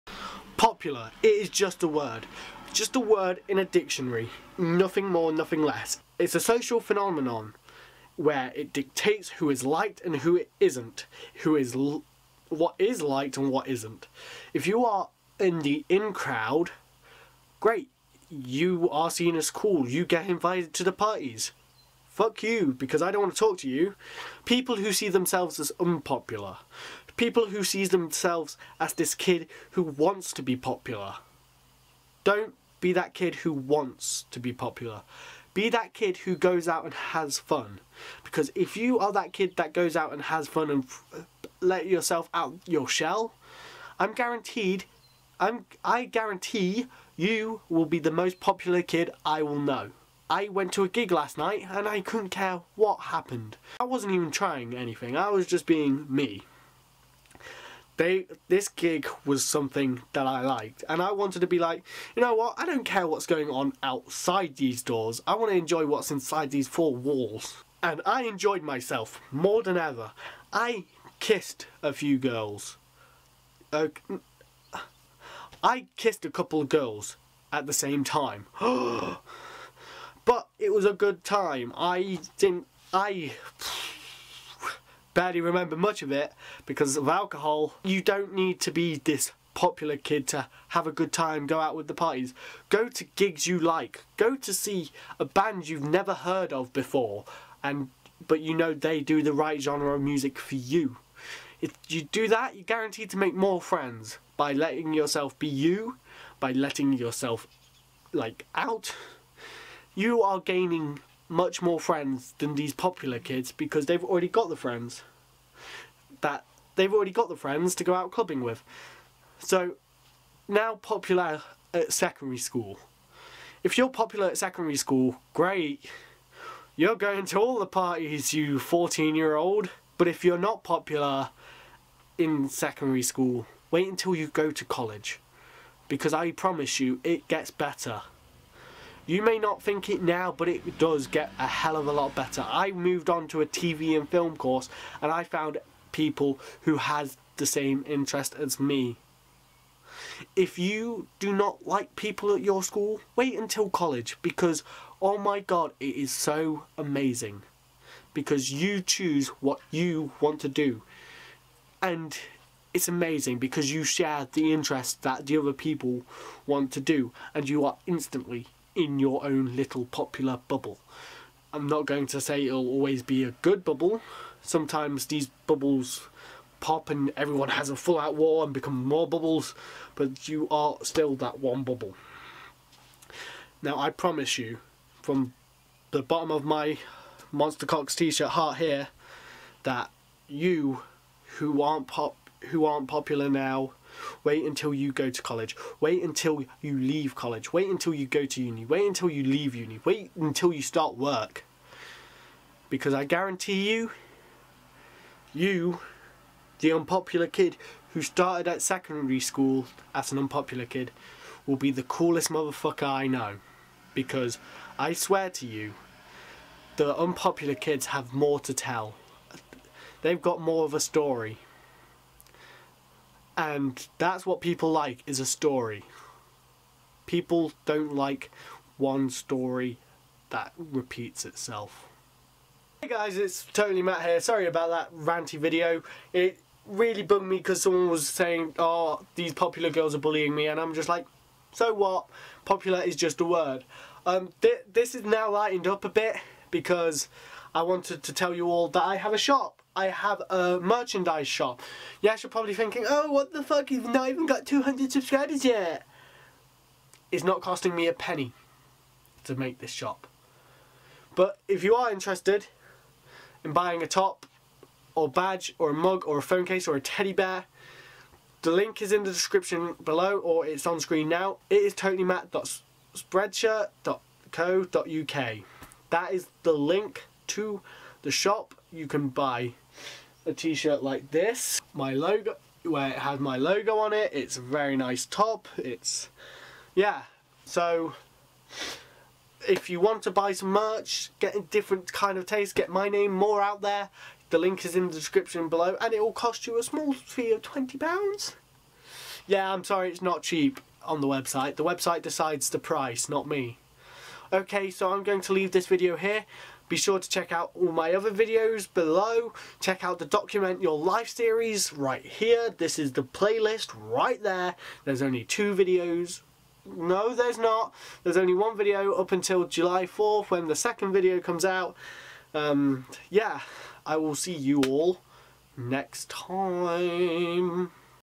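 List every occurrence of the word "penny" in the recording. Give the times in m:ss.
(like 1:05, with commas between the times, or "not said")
4:17.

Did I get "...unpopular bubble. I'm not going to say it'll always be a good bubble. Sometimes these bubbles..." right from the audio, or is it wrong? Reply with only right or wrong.
wrong.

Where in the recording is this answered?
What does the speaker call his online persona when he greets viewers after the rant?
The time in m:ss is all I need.
3:53.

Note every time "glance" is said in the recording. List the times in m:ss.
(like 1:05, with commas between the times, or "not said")
not said.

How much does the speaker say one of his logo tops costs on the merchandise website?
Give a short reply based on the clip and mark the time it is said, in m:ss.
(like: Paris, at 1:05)
£20, at 4:57.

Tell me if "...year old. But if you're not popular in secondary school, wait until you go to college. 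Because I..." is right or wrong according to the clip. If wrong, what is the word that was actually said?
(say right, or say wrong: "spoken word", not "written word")
right.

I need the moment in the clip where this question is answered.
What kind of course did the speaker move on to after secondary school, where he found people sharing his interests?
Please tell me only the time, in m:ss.
2:23.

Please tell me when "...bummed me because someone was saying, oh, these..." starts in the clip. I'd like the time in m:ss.
3:57.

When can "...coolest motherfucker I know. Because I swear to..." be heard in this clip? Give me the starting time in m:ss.
3:31.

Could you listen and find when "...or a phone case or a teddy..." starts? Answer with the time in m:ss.
4:26.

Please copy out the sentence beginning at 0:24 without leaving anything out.
People who see themselves as unpopular, People who sees themselves as this kid who wants to be popular.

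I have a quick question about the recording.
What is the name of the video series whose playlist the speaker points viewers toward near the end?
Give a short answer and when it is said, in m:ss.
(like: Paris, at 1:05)
Document Your Life, at 5:10.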